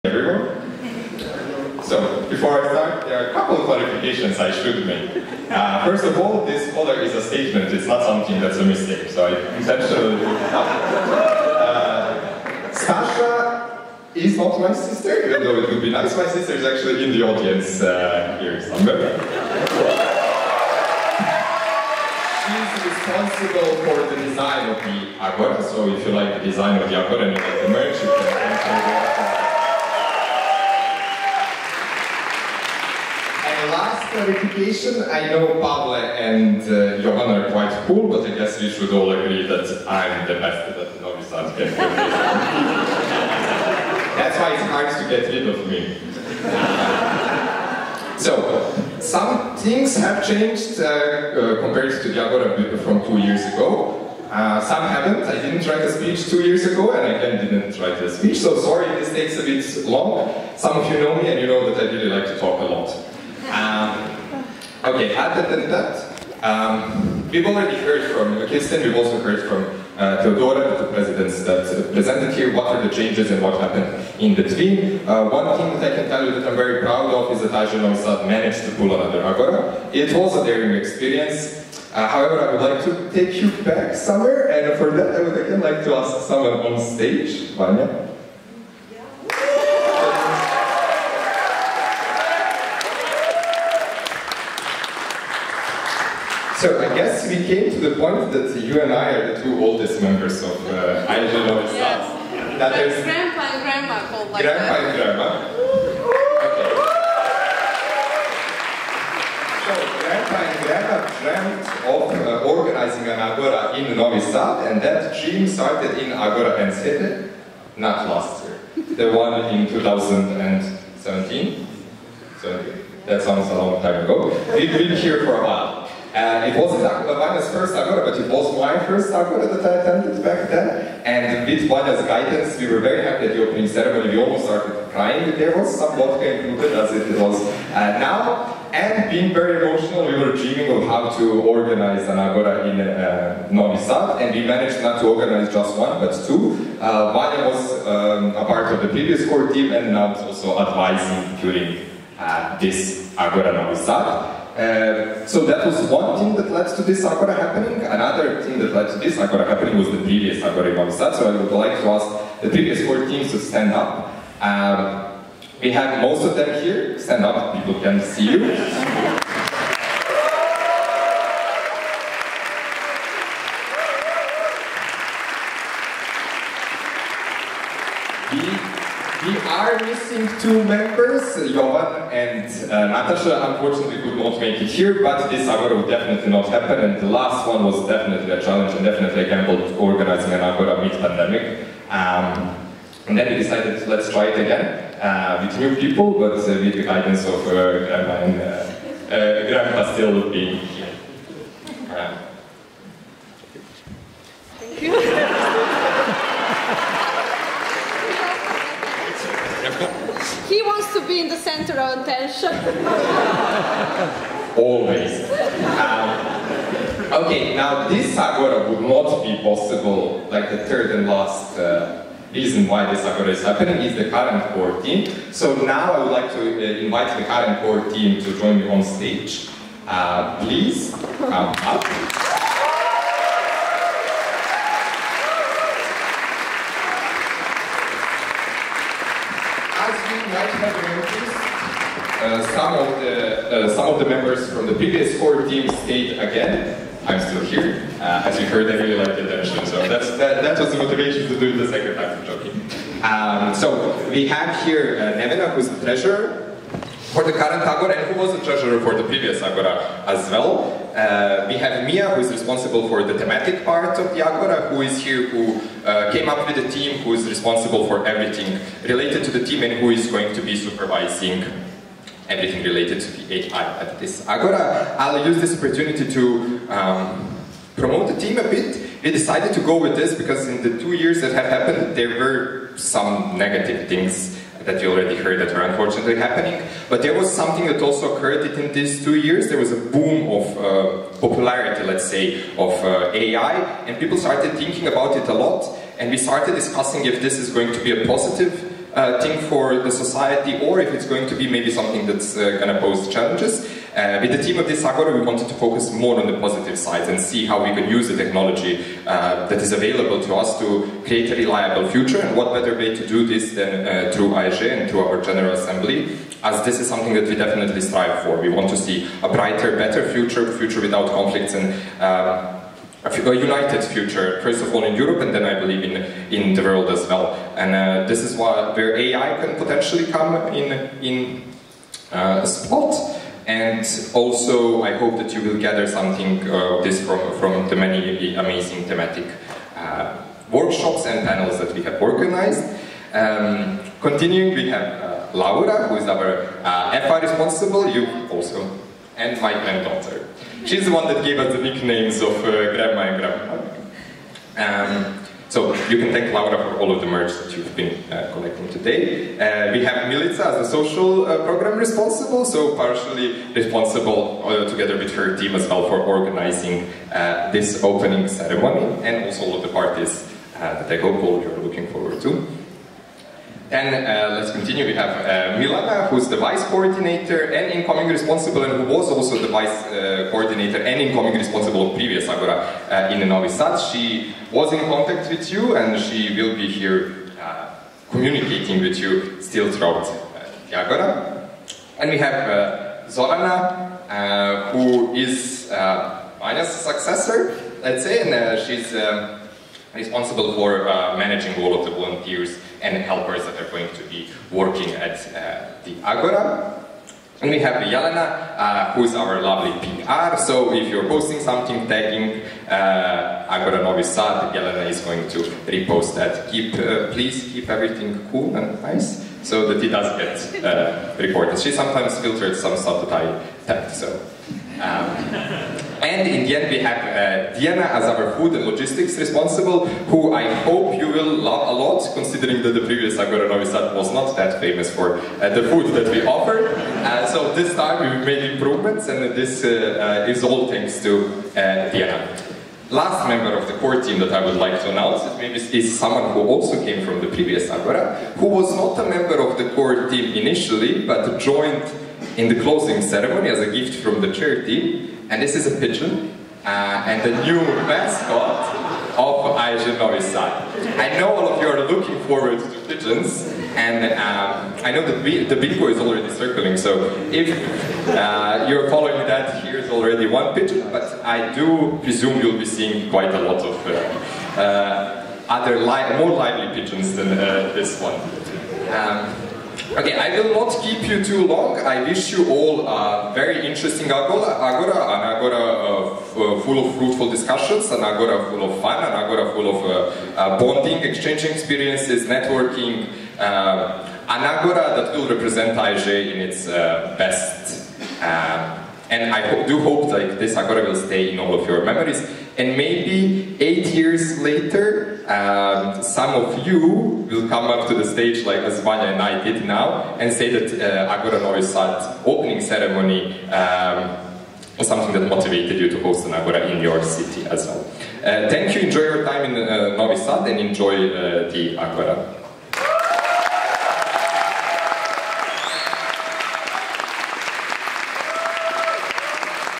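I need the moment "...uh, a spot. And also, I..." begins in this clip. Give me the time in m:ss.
5:32.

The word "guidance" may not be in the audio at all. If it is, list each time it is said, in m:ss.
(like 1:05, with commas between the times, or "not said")
2:12, 3:16.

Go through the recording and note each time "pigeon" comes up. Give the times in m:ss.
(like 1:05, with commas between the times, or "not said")
7:35, 7:42, 7:50, 7:56.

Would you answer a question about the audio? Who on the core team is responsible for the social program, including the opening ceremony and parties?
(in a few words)
Milica.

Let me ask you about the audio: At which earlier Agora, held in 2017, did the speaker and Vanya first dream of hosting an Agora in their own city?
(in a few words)
Agora Enschede.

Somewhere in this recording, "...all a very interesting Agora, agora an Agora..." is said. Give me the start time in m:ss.
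8:02.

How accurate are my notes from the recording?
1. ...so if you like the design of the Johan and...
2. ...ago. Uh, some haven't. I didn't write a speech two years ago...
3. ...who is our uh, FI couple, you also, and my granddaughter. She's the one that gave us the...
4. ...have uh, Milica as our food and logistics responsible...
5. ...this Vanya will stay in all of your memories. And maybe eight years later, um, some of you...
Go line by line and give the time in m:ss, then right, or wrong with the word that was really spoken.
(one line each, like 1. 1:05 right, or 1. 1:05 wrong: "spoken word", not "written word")
1. 0:25 wrong: "Agora", not "Johan"
2. 0:53 right
3. 5:45 wrong: "responsible", not "couple"
4. 7:06 wrong: "Diana", not "Milica"
5. 8:20 wrong: "Agora", not "Vanya".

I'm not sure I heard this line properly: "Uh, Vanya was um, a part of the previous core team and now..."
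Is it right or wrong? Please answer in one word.
right.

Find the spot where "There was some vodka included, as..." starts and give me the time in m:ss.
2:15.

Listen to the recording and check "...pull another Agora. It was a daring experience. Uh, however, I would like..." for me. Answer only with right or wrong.
right.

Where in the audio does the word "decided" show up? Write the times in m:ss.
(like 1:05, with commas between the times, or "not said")
3:13, 4:39.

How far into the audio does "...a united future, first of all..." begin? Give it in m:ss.
5:23.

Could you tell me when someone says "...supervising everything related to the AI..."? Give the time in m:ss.
4:30.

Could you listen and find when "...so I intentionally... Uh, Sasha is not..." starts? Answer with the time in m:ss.
0:09.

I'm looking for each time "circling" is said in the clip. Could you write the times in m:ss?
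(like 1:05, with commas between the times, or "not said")
7:46.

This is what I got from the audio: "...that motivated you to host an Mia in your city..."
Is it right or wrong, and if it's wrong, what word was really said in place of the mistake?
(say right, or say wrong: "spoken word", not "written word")
wrong: "Agora", not "Mia".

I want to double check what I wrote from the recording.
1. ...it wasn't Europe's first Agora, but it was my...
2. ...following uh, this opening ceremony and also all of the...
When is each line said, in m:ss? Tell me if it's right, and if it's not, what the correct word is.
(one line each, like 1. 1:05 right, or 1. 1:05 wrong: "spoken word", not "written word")
1. 2:06 wrong: "Vanya", not "Europe"
2. 6:05 wrong: "organizing", not "following".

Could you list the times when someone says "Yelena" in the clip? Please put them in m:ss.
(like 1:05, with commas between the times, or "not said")
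6:47, 6:54.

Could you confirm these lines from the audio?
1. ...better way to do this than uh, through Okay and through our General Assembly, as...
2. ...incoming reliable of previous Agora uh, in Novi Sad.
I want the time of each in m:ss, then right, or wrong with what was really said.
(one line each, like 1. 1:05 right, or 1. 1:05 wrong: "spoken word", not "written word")
1. 5:12 wrong: "AEGEE", not "Okay"
2. 6:20 wrong: "responsible", not "reliable".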